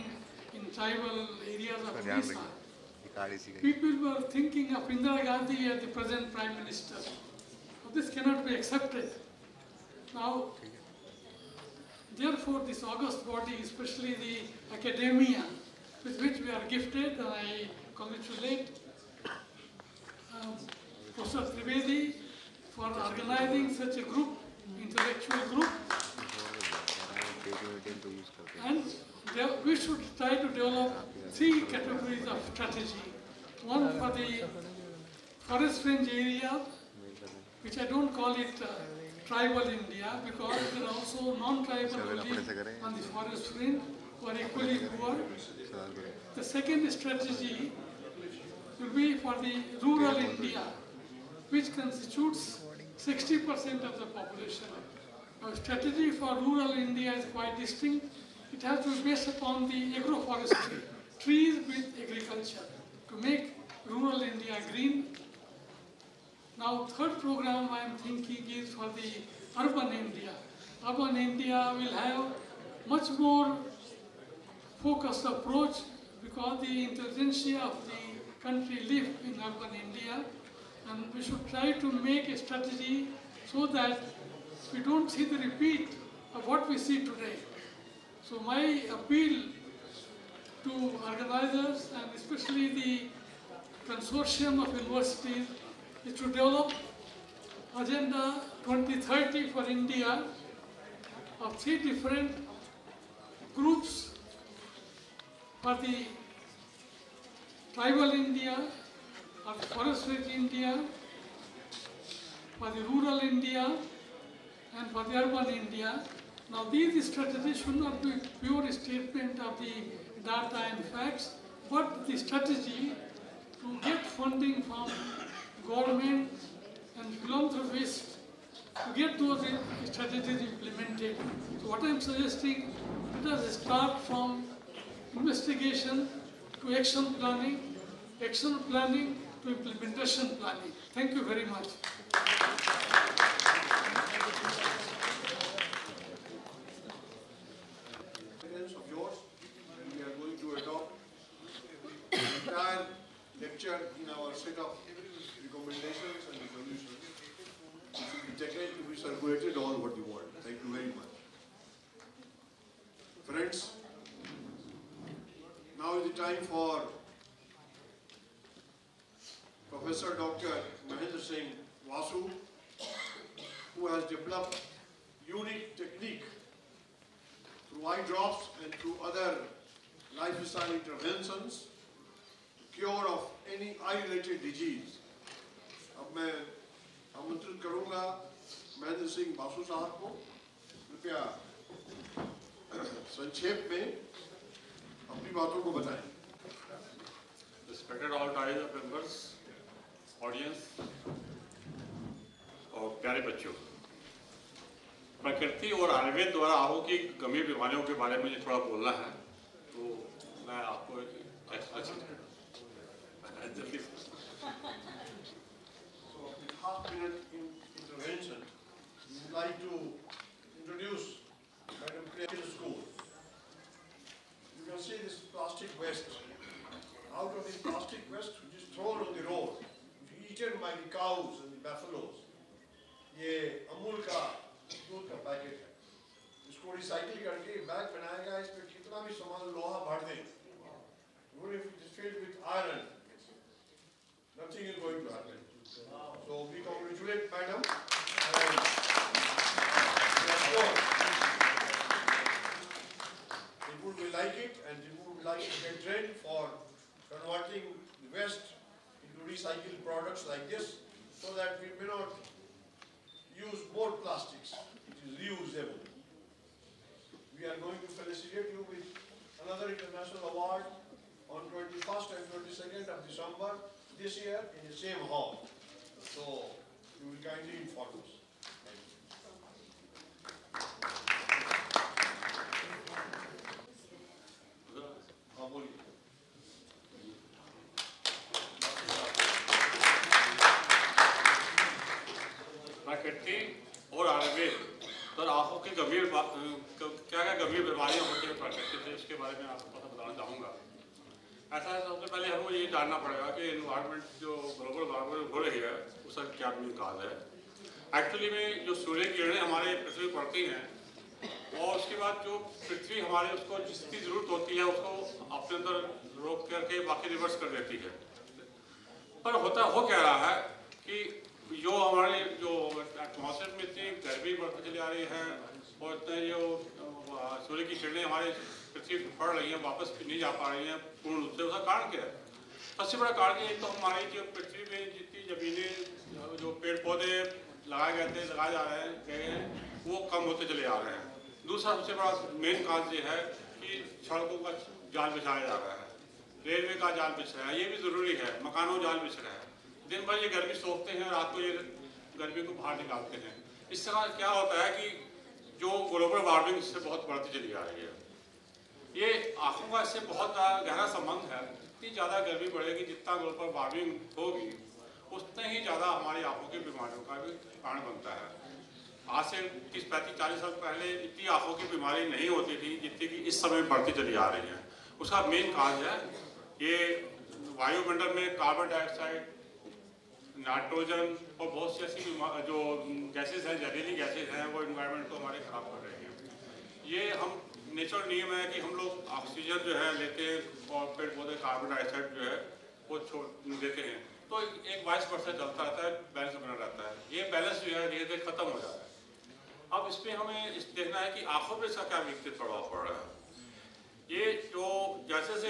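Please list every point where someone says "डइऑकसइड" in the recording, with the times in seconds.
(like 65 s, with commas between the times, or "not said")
378 s, 391 s.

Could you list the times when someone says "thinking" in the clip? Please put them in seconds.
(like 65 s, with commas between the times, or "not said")
4 s, 67 s.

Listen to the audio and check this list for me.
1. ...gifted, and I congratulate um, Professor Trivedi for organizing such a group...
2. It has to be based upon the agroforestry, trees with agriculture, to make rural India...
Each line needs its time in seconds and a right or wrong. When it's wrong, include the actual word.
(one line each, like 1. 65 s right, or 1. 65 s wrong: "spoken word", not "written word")
1. 16 s right
2. 58 s right.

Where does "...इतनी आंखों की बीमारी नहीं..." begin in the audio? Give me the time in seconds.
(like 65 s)
371 s.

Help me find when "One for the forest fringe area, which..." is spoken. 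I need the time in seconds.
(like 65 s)
33 s.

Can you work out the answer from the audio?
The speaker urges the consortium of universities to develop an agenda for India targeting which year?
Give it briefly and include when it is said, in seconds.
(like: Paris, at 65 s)
2030, at 97 s.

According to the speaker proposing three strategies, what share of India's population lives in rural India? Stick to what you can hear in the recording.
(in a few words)
60%.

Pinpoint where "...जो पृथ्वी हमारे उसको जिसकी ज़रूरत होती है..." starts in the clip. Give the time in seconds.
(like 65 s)
312 s.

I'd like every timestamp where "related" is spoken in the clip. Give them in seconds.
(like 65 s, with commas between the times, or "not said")
184 s.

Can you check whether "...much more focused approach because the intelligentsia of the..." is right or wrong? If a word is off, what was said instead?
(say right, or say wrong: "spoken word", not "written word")
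right.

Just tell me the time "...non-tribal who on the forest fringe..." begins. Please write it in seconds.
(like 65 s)
41 s.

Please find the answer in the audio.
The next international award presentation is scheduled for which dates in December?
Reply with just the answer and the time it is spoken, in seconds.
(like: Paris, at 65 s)
21st and 22nd, at 271 s.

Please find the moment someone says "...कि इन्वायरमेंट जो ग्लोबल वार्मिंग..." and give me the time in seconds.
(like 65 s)
303 s.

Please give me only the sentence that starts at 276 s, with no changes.
So you will kindly inform us.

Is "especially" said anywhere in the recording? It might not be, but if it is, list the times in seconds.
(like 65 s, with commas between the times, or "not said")
13 s, 92 s.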